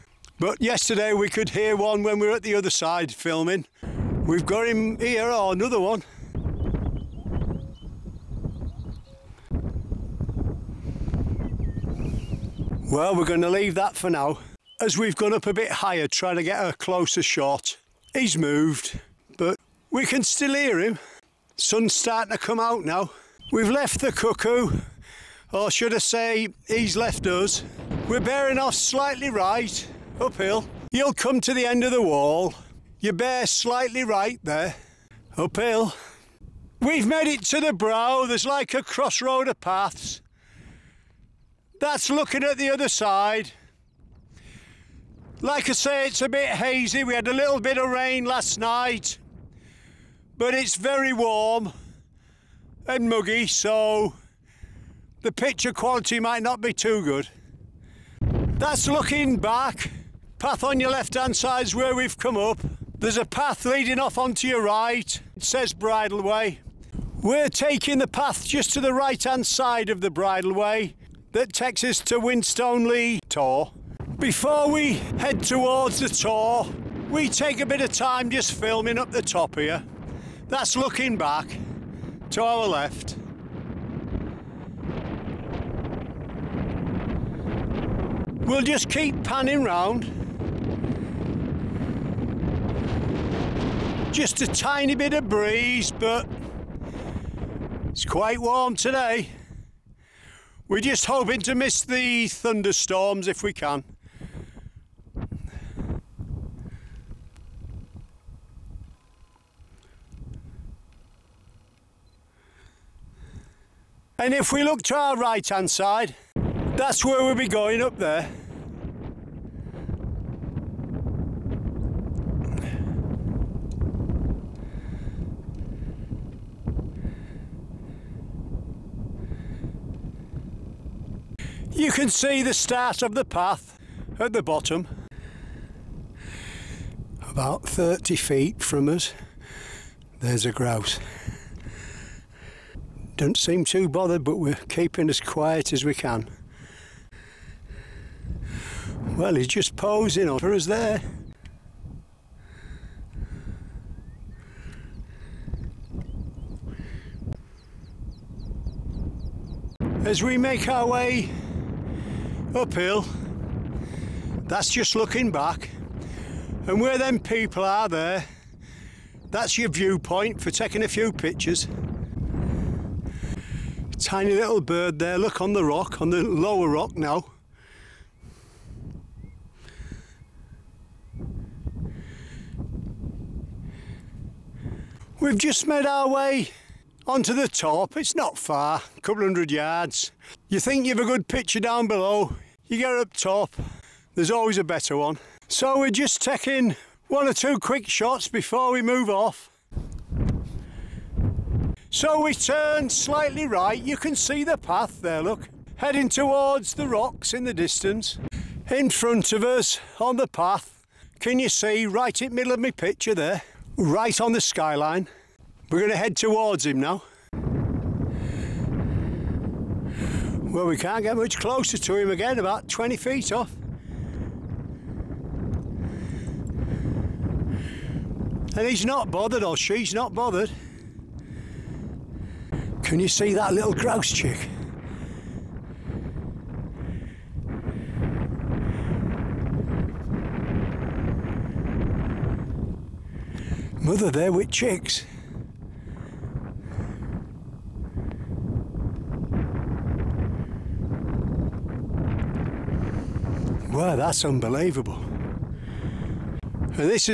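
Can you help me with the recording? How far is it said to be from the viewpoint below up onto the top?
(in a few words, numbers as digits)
A couple hundred yards.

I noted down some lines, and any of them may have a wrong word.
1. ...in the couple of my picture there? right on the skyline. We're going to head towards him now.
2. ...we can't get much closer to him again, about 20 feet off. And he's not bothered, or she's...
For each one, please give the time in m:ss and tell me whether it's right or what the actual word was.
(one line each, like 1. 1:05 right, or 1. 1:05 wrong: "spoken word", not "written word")
1. 3:32 wrong: "middle", not "couple"
2. 3:40 right.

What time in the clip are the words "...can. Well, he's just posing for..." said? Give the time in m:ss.
2:25.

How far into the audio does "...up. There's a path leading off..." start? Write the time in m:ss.
1:02.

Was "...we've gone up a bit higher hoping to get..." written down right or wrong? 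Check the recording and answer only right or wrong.
wrong.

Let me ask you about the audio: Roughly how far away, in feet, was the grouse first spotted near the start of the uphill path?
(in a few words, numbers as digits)
30 feet.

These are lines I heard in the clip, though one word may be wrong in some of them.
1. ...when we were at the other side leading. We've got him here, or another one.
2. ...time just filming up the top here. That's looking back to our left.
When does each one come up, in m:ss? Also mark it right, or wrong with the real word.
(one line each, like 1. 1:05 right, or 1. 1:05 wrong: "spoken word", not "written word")
1. 0:02 wrong: "filming", not "leading"
2. 1:17 right.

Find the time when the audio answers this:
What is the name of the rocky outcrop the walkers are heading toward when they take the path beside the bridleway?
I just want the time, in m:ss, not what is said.
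1:12.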